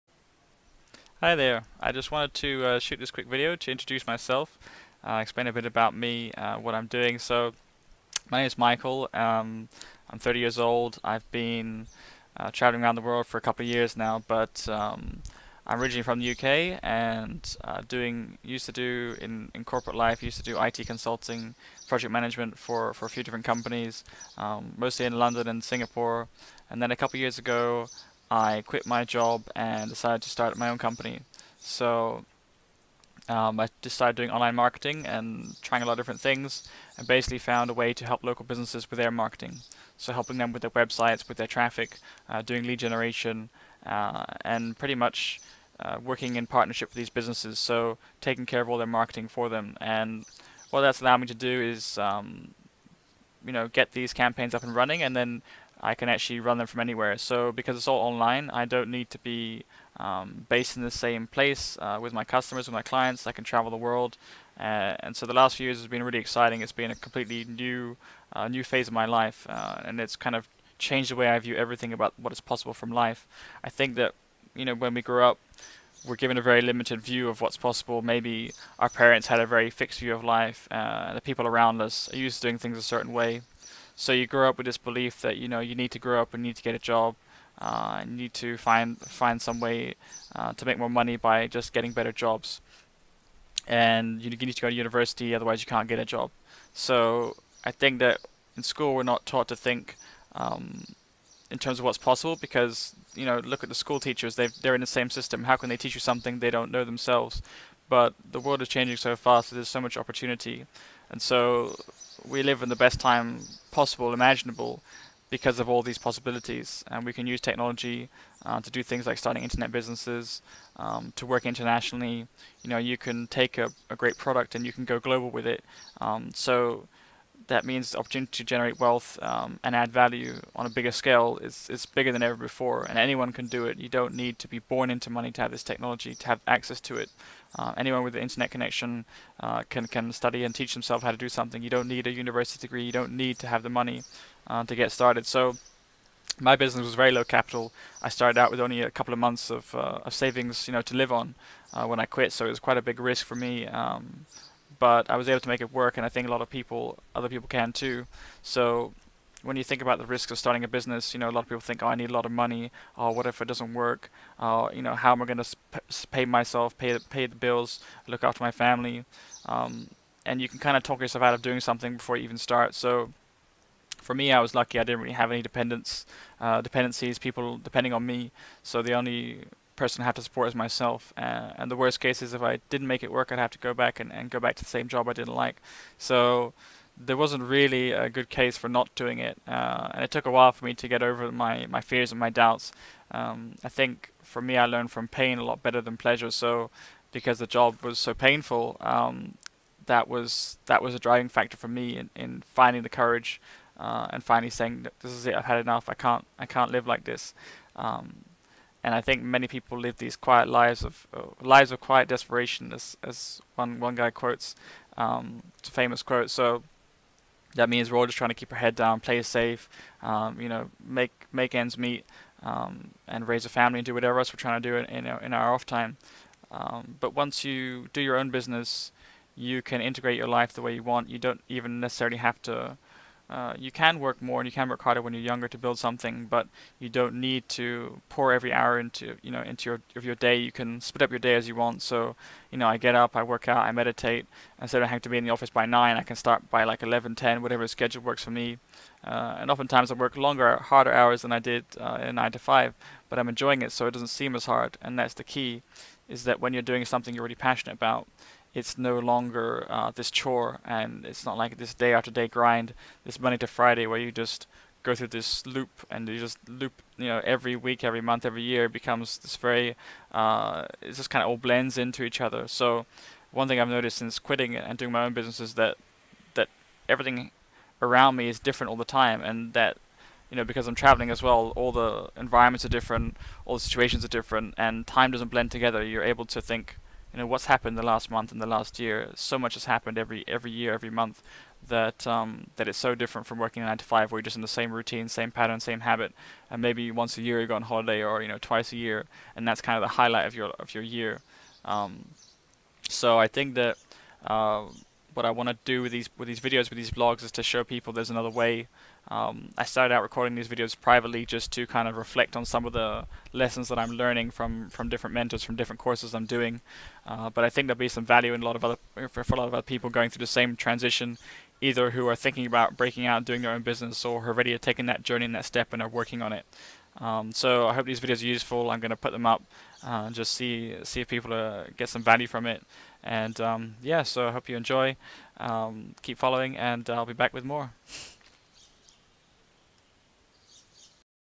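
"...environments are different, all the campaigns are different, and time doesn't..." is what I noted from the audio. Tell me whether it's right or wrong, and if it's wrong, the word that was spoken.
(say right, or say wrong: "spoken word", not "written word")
wrong: "situations", not "campaigns".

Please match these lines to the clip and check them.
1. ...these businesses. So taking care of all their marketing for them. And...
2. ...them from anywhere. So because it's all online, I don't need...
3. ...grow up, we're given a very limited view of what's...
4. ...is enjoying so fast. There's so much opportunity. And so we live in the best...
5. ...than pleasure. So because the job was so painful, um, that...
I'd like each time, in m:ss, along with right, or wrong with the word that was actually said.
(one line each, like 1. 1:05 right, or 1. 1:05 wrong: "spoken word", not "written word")
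1. 0:46 right
2. 0:56 right
3. 1:15 right
4. 1:48 wrong: "changing", not "enjoying"
5. 3:15 right.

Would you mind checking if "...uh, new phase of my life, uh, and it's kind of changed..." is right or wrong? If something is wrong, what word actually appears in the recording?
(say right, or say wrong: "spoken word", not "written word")
right.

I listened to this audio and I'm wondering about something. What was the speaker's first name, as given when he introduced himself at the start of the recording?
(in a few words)
Michael.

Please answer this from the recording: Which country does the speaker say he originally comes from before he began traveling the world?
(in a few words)
UK.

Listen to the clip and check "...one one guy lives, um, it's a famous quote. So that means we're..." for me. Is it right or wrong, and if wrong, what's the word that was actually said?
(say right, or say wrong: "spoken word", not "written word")
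wrong: "quotes", not "lives".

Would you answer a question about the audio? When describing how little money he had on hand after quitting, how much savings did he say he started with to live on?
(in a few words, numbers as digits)
a couple of months.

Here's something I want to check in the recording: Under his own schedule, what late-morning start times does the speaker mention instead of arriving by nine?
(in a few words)
11 or 10.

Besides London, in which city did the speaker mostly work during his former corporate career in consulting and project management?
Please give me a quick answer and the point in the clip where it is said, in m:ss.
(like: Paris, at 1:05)
Singapore, at 0:25.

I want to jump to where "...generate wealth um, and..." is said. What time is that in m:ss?
2:08.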